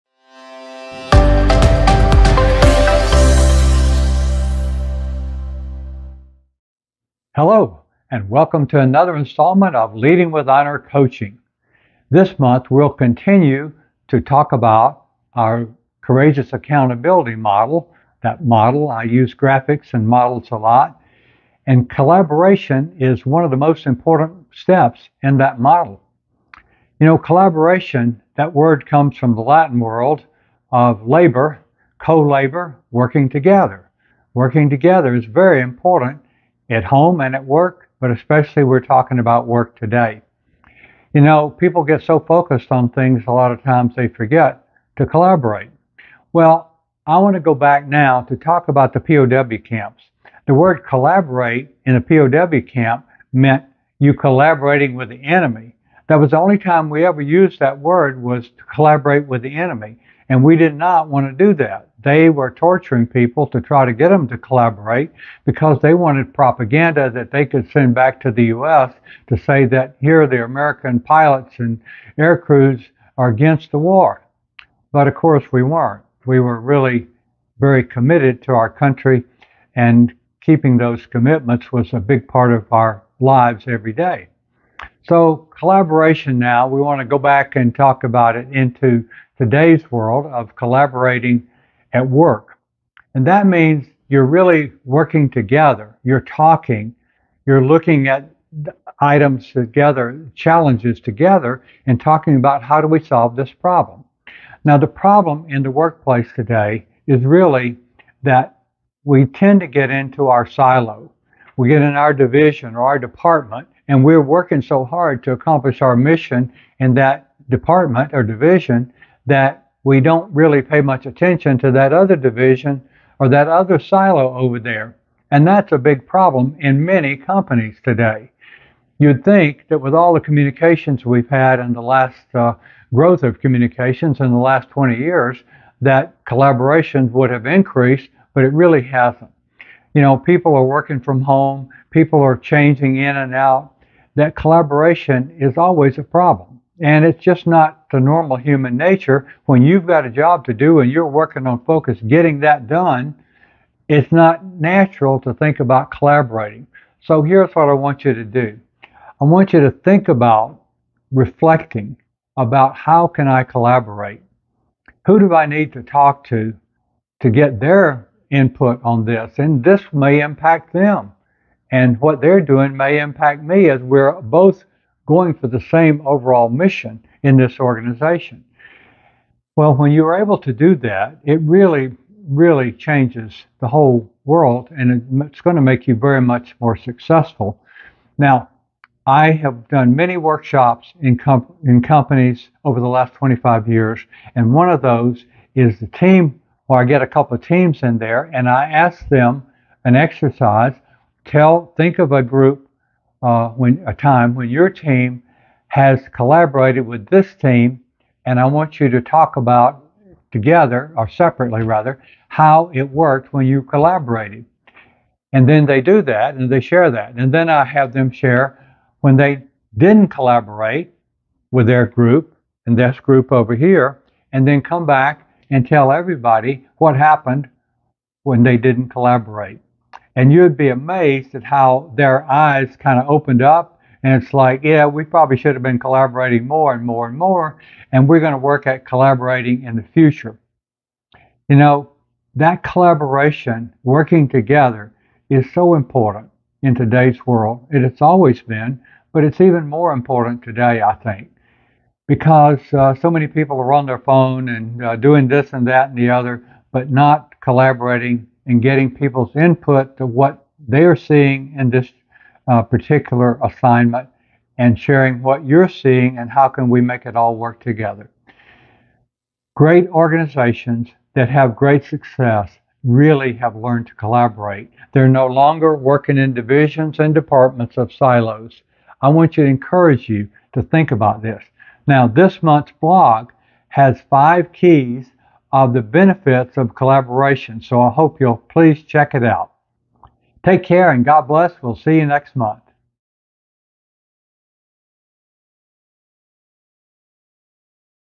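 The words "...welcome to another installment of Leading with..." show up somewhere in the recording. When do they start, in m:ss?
0:08.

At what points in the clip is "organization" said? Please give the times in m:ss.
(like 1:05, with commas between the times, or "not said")
2:57, 4:29.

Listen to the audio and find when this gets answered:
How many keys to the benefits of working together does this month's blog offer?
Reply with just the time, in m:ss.
4:44.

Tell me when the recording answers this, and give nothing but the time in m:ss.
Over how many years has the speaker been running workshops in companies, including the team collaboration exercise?
3:13.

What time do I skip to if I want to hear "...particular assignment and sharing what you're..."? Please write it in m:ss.
4:22.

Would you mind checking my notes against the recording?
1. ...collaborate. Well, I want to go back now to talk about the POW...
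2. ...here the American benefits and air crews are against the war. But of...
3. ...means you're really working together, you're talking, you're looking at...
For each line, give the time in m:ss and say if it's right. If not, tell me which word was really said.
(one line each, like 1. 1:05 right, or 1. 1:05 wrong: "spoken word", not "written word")
1. 0:45 right
2. 1:10 wrong: "pilots", not "benefits"
3. 1:33 right.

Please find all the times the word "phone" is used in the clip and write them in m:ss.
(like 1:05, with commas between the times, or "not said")
4:13.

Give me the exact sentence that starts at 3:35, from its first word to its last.
And then they do that and they share that.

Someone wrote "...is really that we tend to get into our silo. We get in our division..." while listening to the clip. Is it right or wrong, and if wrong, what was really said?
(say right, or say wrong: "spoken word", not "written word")
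right.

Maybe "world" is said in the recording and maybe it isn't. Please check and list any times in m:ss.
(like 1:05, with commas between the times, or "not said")
0:29, 1:29, 3:04, 4:07.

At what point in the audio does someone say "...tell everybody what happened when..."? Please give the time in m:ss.
3:45.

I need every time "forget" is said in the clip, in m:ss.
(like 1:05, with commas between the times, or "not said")
0:44.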